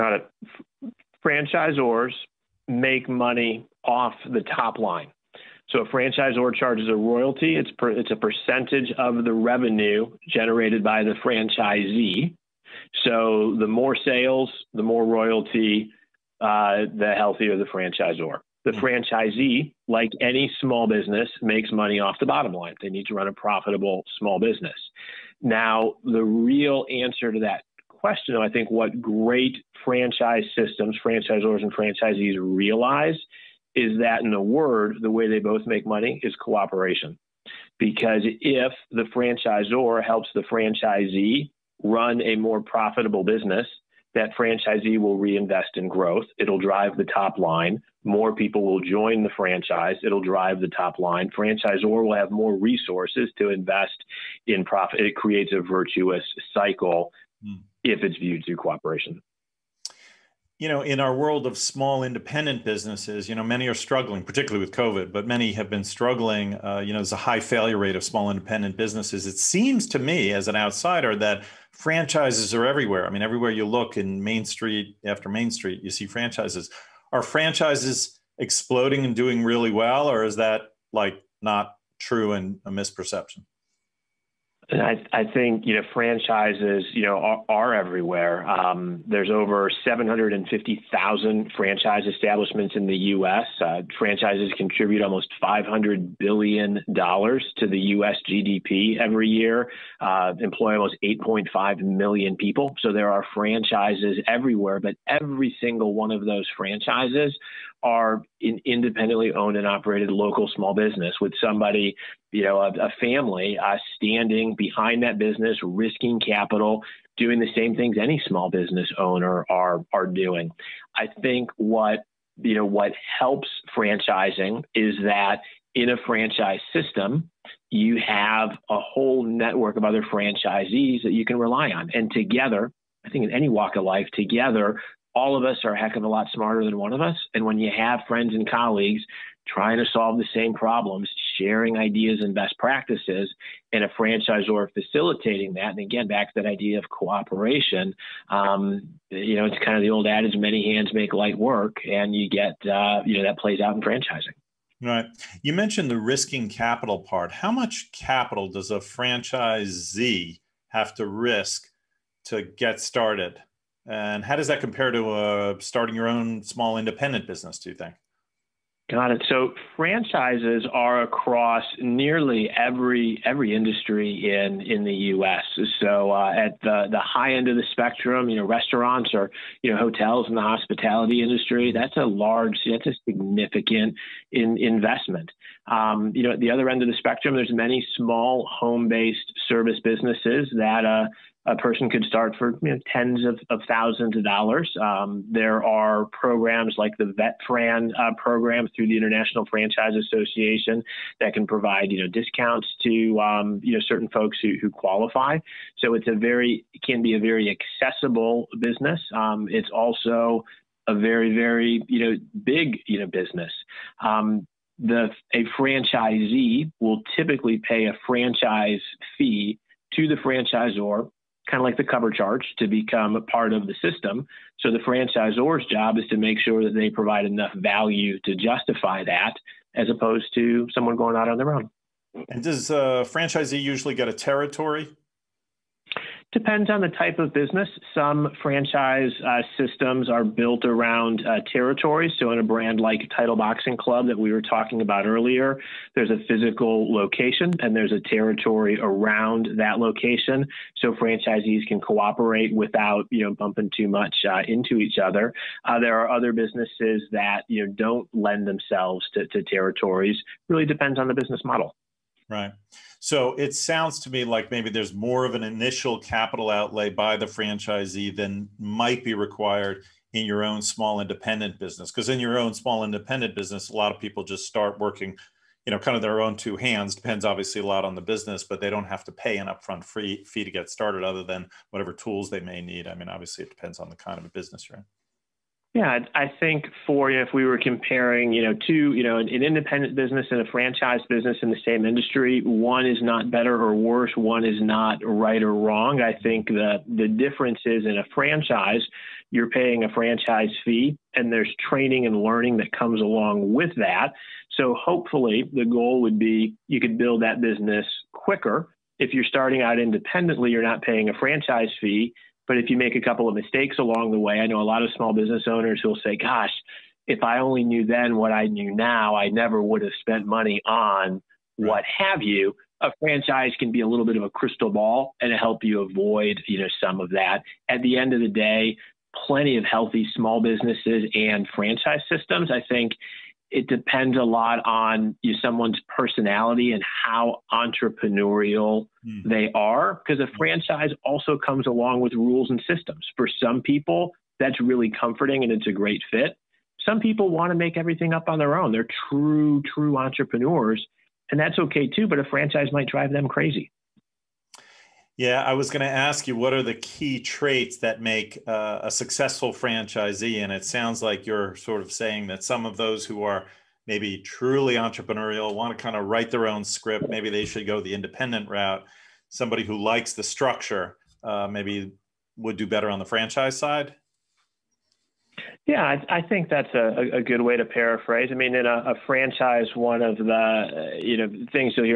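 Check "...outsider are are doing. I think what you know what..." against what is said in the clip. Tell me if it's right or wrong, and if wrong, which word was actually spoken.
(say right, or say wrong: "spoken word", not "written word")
wrong: "owner", not "outsider".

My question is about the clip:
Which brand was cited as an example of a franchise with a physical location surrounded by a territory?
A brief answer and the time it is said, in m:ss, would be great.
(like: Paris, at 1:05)
Title Boxing Club, at 4:03.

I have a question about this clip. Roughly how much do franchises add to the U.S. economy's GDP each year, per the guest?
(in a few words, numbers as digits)
almost 500 billion dollars.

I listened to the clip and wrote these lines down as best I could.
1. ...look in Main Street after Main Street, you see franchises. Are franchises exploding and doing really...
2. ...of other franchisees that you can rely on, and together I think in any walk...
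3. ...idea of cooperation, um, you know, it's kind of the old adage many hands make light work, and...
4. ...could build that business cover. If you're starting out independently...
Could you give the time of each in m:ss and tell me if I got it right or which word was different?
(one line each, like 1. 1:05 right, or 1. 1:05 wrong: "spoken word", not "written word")
1. 1:13 right
2. 2:09 right
3. 2:26 right
4. 5:06 wrong: "quicker", not "cover".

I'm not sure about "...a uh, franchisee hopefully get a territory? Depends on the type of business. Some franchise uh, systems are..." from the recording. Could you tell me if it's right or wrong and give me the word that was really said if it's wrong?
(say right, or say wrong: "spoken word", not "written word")
wrong: "usually", not "hopefully".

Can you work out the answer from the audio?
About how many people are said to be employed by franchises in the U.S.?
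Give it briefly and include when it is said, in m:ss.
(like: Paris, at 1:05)
almost 8.5 million, at 1:40.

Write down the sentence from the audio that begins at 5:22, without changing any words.
A franchise can be a little bit of a crystal ball and help you avoid, you know, some of that.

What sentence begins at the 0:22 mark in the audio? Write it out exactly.
They need to run a profitable small business.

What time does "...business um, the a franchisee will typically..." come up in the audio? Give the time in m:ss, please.
3:33.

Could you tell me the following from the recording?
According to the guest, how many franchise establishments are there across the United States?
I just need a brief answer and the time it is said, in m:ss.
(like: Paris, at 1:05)
over 750,000, at 1:29.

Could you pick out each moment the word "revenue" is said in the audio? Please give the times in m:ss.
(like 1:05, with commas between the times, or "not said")
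0:09.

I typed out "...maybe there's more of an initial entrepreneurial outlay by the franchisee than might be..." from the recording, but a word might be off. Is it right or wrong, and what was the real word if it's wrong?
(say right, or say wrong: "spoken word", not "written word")
wrong: "capital", not "entrepreneurial".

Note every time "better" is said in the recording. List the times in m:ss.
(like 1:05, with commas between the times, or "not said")
4:53, 6:12.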